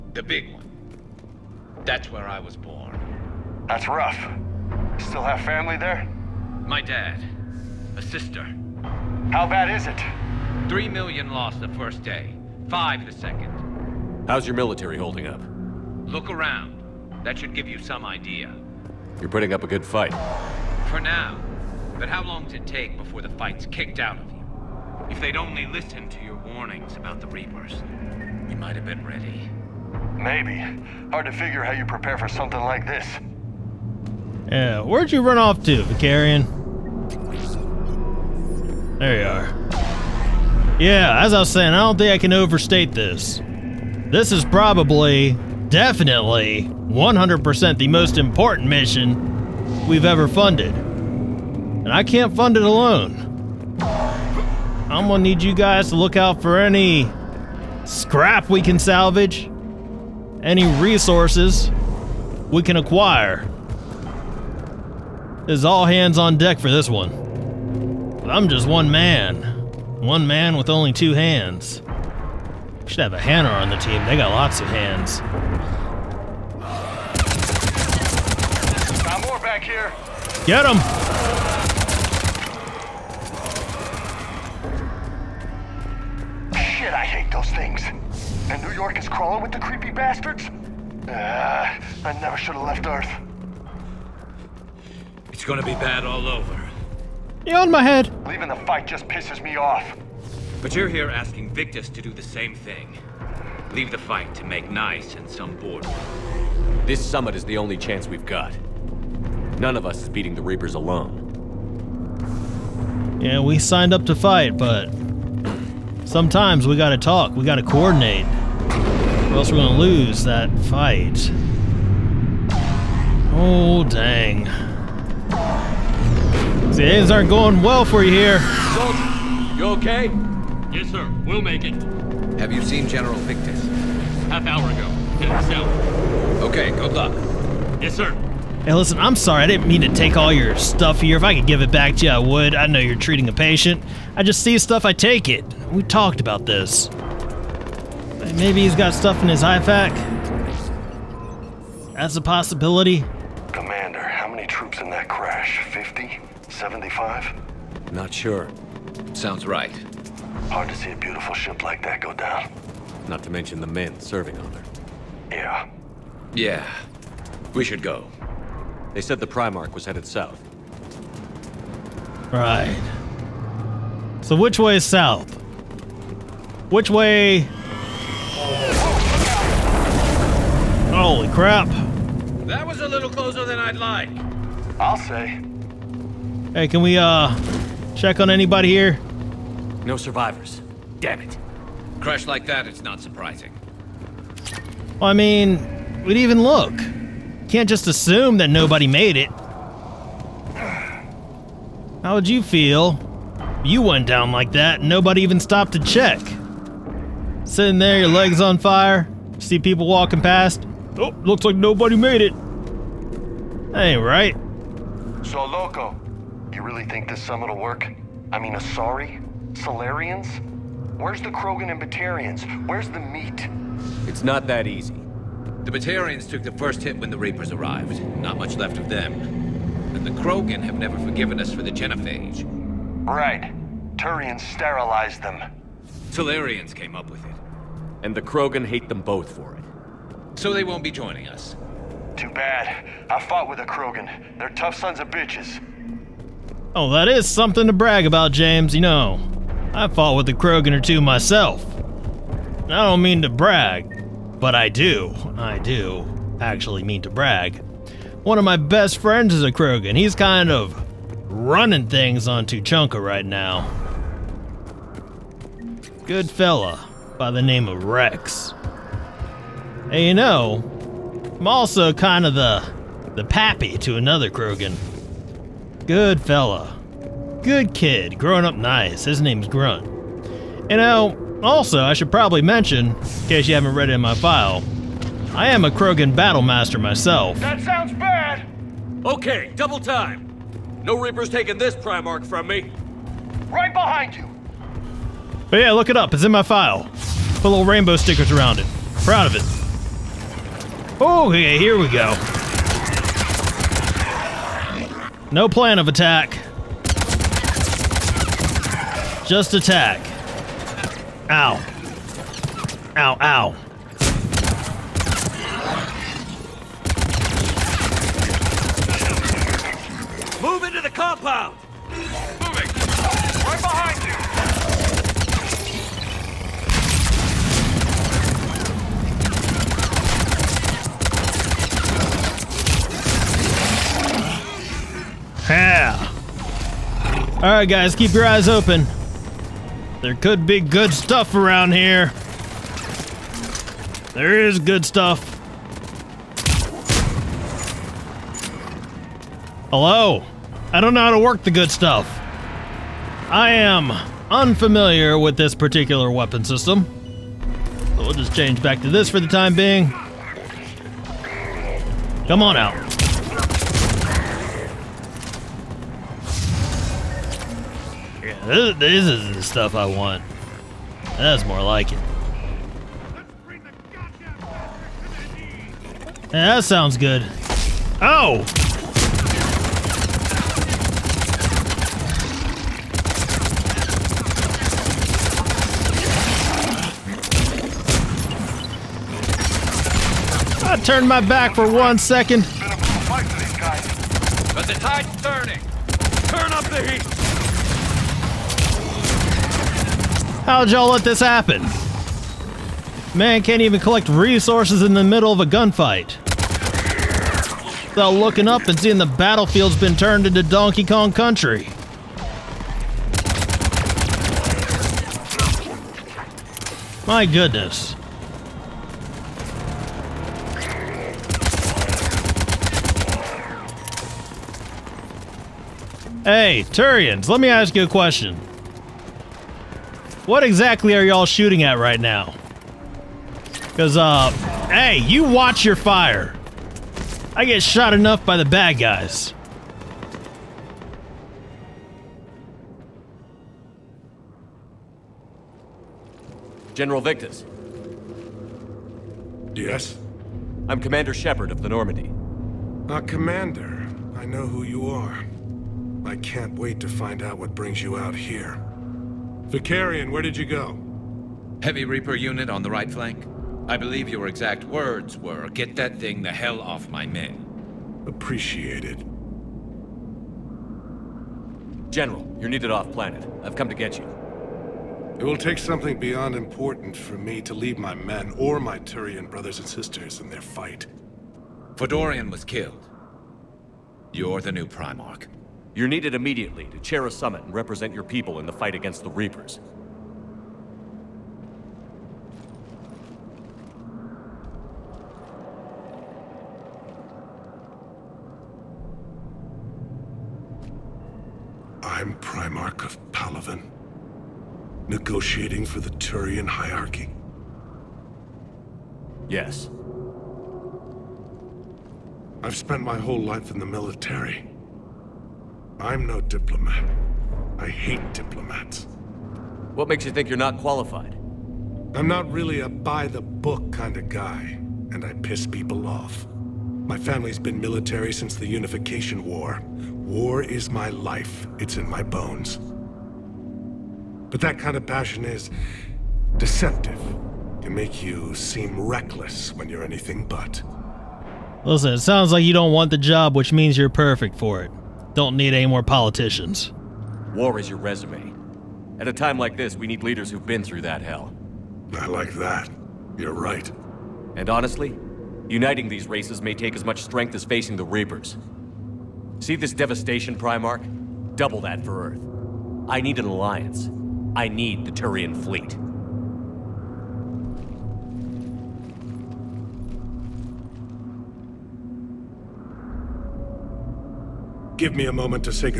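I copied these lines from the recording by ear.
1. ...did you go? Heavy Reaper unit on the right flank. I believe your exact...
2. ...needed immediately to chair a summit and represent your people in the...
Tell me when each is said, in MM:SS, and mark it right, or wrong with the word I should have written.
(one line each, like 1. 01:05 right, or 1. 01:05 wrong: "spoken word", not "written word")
1. 07:40 right
2. 08:05 right.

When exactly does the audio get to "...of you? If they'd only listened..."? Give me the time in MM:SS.
00:24.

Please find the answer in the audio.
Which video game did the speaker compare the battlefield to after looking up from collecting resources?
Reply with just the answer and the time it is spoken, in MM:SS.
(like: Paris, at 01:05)
Donkey Kong Country, at 06:50.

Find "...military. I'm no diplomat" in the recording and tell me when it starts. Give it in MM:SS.
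08:33.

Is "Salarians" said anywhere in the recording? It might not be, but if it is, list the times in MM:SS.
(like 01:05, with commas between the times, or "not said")
03:39, 03:56.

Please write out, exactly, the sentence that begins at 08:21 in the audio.
I'm Primarch of Palaven, negotiating for the Turian hierarchy.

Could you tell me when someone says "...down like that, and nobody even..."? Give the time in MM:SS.
03:24.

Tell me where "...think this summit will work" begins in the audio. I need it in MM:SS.
03:36.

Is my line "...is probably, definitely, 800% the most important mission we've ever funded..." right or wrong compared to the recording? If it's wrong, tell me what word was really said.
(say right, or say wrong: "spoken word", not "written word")
wrong: "100", not "800".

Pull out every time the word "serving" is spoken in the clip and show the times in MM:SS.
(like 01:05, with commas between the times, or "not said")
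02:43.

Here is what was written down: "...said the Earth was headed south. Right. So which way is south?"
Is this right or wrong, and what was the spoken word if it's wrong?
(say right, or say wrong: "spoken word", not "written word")
wrong: "Primarch", not "Earth".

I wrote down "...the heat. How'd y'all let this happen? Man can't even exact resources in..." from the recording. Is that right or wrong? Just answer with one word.
wrong.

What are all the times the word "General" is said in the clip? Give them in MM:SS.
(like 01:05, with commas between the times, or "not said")
02:12, 07:26, 07:51.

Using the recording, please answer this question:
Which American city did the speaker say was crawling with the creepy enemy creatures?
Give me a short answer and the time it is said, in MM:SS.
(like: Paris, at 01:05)
New York, at 01:28.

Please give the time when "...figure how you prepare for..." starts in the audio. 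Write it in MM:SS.
00:31.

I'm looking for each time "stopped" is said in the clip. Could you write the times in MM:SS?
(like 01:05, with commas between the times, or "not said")
03:25.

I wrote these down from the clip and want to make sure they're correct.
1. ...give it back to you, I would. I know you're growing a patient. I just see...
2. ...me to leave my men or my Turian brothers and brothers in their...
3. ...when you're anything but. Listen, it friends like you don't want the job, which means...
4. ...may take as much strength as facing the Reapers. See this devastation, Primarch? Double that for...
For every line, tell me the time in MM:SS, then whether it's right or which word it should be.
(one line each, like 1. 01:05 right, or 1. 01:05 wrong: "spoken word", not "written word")
1. 02:21 wrong: "treating", not "growing"
2. 07:57 wrong: "sisters", not "brothers"
3. 08:59 wrong: "sounds", not "friends"
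4. 09:16 right.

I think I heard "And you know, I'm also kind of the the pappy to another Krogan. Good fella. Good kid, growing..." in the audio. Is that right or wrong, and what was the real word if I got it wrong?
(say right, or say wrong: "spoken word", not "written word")
right.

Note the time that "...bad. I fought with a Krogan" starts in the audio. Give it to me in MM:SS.
04:02.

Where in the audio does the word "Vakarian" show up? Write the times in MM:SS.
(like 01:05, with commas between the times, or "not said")
00:35, 07:39.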